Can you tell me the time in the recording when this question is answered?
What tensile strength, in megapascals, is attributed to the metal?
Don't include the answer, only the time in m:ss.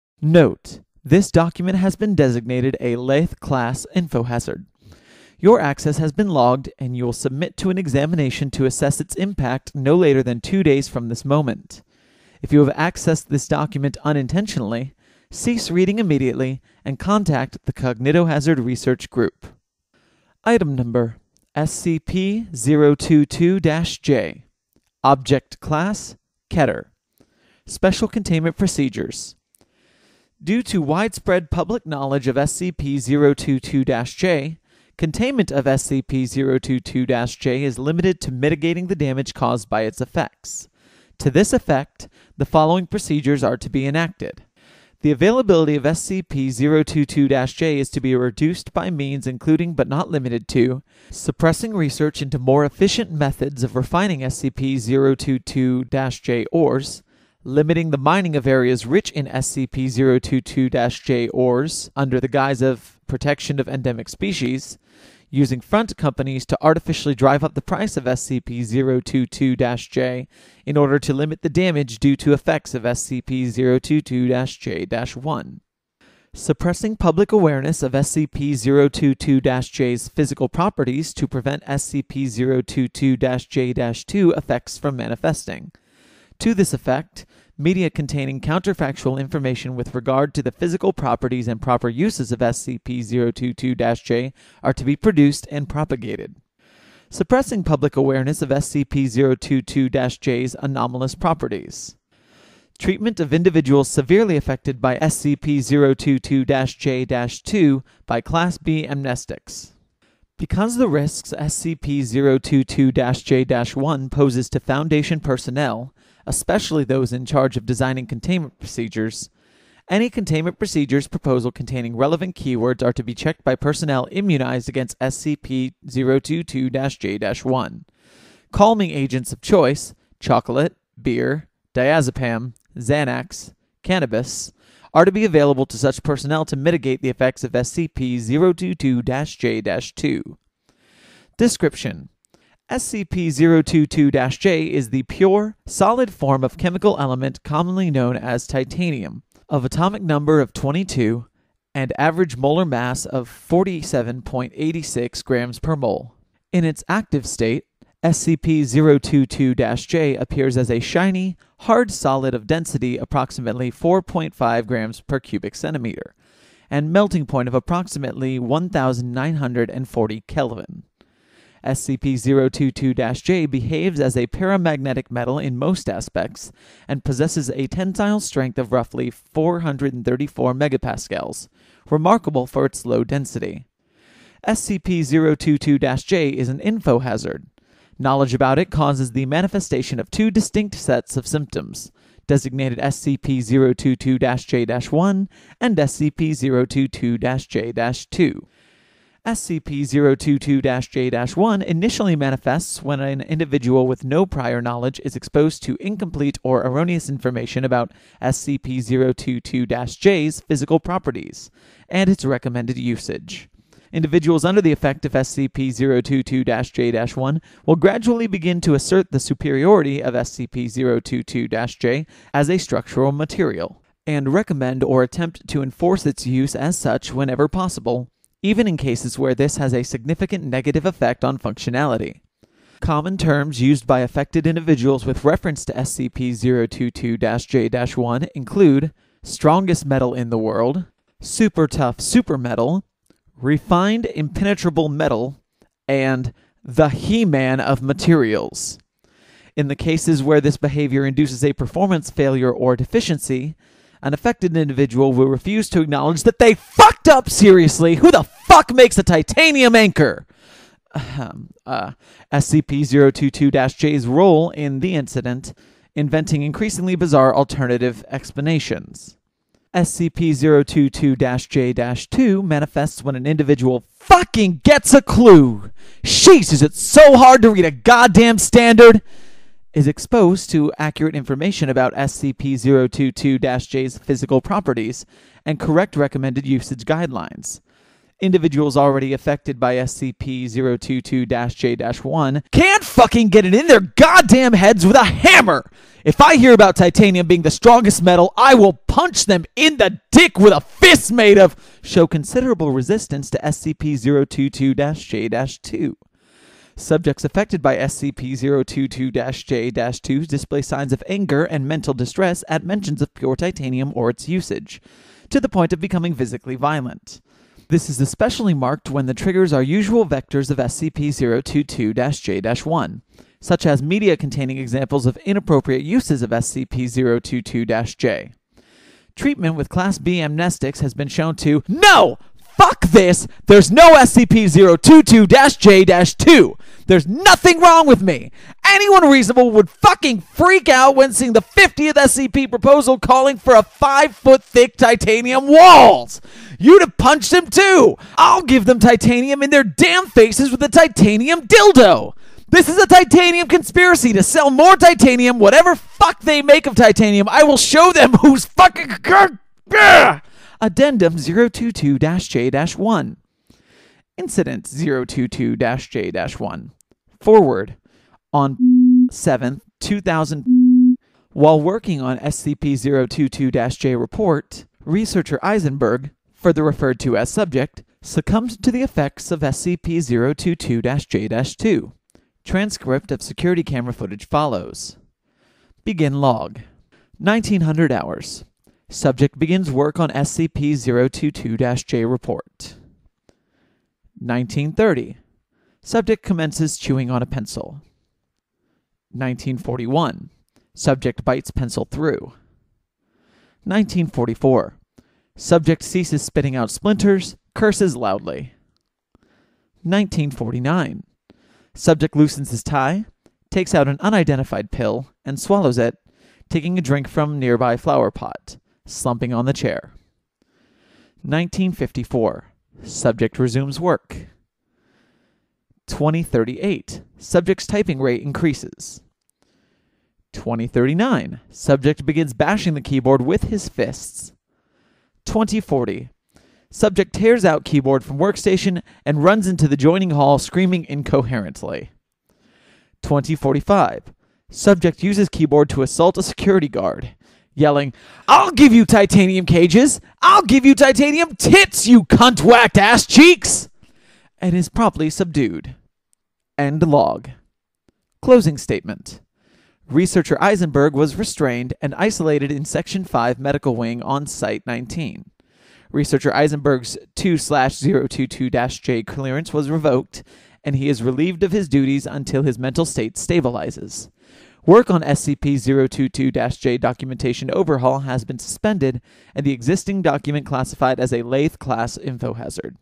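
2:59.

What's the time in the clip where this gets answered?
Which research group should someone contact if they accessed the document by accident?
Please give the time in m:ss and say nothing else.
0:17.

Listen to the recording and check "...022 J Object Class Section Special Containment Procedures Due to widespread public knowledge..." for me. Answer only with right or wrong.
wrong.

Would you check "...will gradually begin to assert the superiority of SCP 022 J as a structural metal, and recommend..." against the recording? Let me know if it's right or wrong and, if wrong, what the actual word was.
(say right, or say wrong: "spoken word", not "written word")
wrong: "material", not "metal".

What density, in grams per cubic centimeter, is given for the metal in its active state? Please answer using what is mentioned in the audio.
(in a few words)
4.5.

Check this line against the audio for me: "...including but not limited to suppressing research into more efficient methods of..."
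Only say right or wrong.
right.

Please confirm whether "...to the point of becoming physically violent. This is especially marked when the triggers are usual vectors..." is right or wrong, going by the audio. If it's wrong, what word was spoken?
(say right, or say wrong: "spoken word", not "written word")
right.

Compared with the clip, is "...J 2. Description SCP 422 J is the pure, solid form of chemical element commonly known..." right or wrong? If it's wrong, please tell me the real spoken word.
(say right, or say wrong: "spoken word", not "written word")
wrong: "022", not "422".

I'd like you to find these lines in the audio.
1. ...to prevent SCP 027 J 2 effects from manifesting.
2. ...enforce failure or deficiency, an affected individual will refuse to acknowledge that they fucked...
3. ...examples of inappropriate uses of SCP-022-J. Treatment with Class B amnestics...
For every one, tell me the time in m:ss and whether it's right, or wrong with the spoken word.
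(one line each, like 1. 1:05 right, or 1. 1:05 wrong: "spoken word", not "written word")
1. 1:21 wrong: "022", not "027"
2. 4:11 wrong: "performance", not "enforce"
3. 5:24 right.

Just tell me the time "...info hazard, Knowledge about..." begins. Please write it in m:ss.
3:06.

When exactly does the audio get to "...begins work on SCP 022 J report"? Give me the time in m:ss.
6:29.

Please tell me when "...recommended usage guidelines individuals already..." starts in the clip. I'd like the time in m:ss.
4:45.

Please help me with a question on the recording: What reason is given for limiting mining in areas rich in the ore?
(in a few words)
Protection of endemic species.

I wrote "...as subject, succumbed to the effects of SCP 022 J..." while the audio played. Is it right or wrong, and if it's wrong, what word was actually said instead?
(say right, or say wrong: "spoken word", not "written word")
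right.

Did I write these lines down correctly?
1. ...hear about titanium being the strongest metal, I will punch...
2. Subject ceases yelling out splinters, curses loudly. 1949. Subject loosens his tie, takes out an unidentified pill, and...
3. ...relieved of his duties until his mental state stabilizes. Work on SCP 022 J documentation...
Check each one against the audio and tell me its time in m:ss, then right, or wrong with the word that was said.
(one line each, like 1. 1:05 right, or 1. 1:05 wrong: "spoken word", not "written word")
1. 4:56 right
2. 6:45 wrong: "spitting", not "yelling"
3. 7:51 right.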